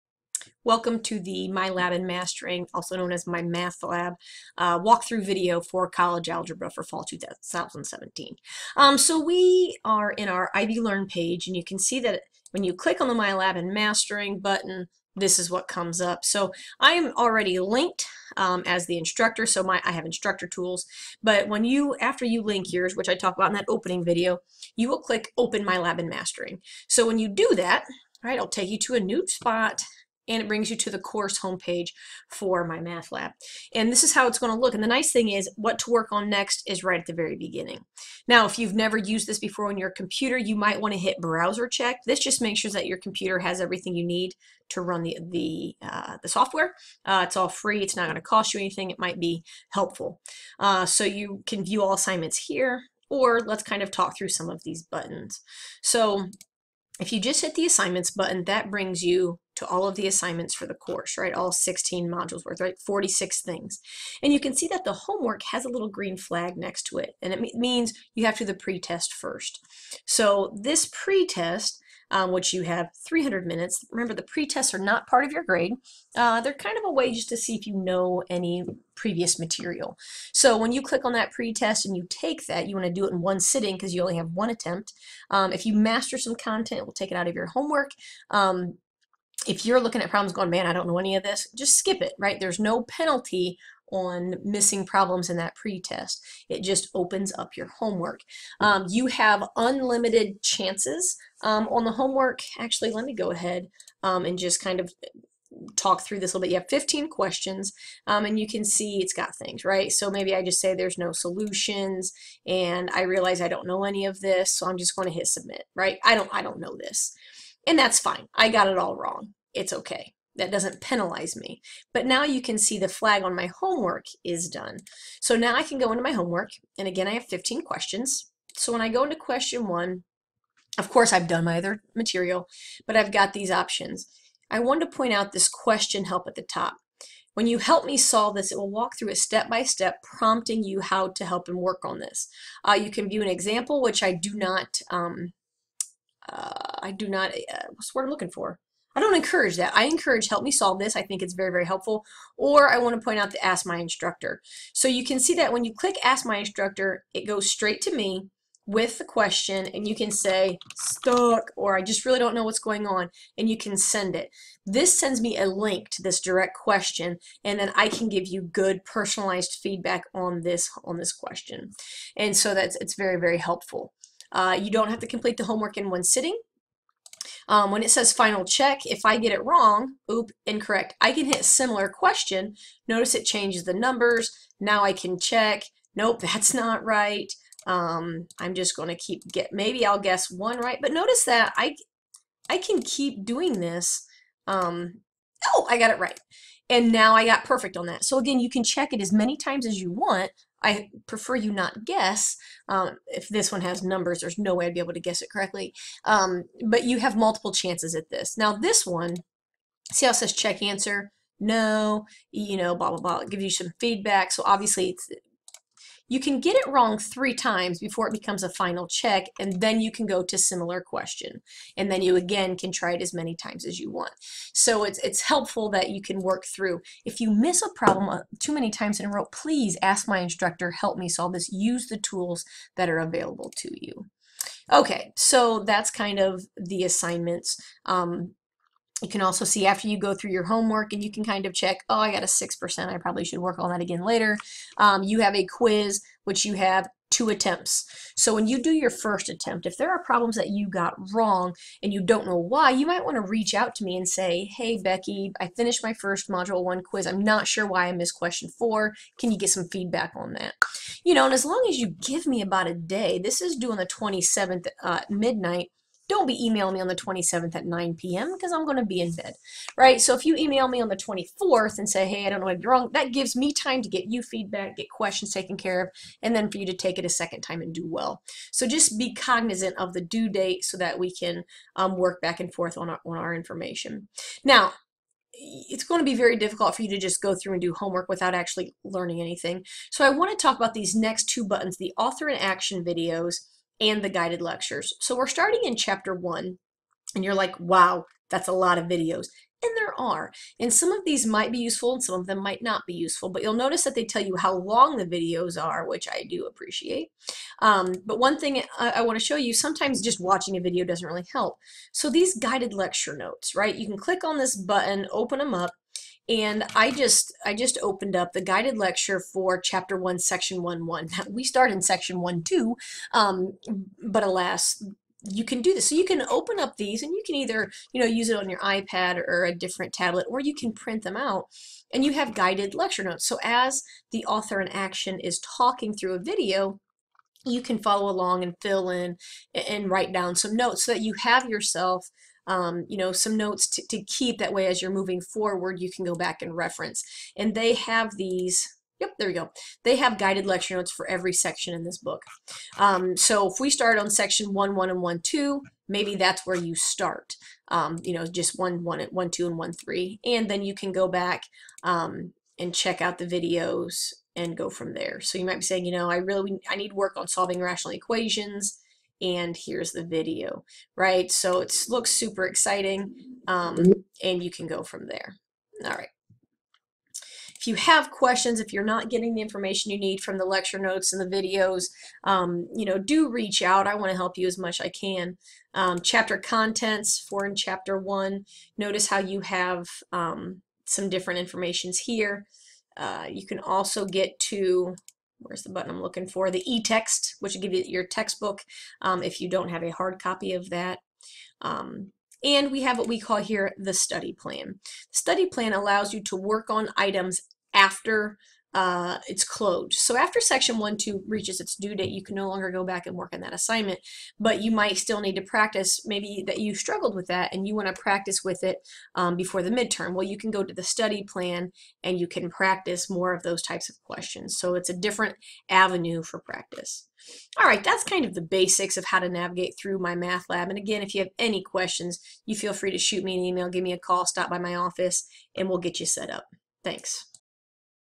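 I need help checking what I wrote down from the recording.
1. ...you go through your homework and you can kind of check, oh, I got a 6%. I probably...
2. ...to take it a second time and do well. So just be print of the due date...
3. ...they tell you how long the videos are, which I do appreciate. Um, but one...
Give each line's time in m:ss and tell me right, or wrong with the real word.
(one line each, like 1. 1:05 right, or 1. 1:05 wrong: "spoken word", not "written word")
1. 3:59 right
2. 4:36 wrong: "cognizant", not "print"
3. 5:03 right.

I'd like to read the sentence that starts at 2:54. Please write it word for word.
Uh, you don't have to complete the homework in one sitting.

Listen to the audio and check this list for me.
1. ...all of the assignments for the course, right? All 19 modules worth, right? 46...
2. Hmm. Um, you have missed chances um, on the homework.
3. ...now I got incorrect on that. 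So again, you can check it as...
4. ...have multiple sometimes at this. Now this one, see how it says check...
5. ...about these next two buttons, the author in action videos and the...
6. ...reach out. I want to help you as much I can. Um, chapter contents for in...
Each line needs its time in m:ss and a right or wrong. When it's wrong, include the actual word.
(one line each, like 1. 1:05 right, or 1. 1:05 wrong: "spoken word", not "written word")
1. 0:59 wrong: "16", not "19"
2. 1:38 wrong: "unlimited", not "missed"
3. 3:16 wrong: "perfect", not "incorrect"
4. 3:26 wrong: "chances", not "sometimes"
5. 4:50 right
6. 6:23 right.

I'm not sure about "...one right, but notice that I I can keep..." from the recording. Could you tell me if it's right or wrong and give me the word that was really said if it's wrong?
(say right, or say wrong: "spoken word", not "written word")
right.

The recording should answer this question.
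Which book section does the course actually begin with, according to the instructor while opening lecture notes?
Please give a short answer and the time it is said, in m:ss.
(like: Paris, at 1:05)
1.2, at 5:21.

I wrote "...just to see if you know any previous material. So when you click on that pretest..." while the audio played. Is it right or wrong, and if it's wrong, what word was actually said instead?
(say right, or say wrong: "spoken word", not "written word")
right.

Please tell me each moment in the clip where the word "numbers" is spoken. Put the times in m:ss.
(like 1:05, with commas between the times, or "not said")
3:03, 3:23.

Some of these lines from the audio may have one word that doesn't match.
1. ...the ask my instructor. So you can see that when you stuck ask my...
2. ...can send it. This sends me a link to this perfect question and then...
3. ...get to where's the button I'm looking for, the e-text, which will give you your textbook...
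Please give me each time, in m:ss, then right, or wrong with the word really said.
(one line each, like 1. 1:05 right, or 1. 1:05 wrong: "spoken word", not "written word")
1. 2:33 wrong: "click", not "stuck"
2. 2:43 wrong: "direct", not "perfect"
3. 6:34 right.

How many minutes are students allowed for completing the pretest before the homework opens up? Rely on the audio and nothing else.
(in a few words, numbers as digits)
300.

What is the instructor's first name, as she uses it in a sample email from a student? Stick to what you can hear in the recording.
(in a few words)
Becky.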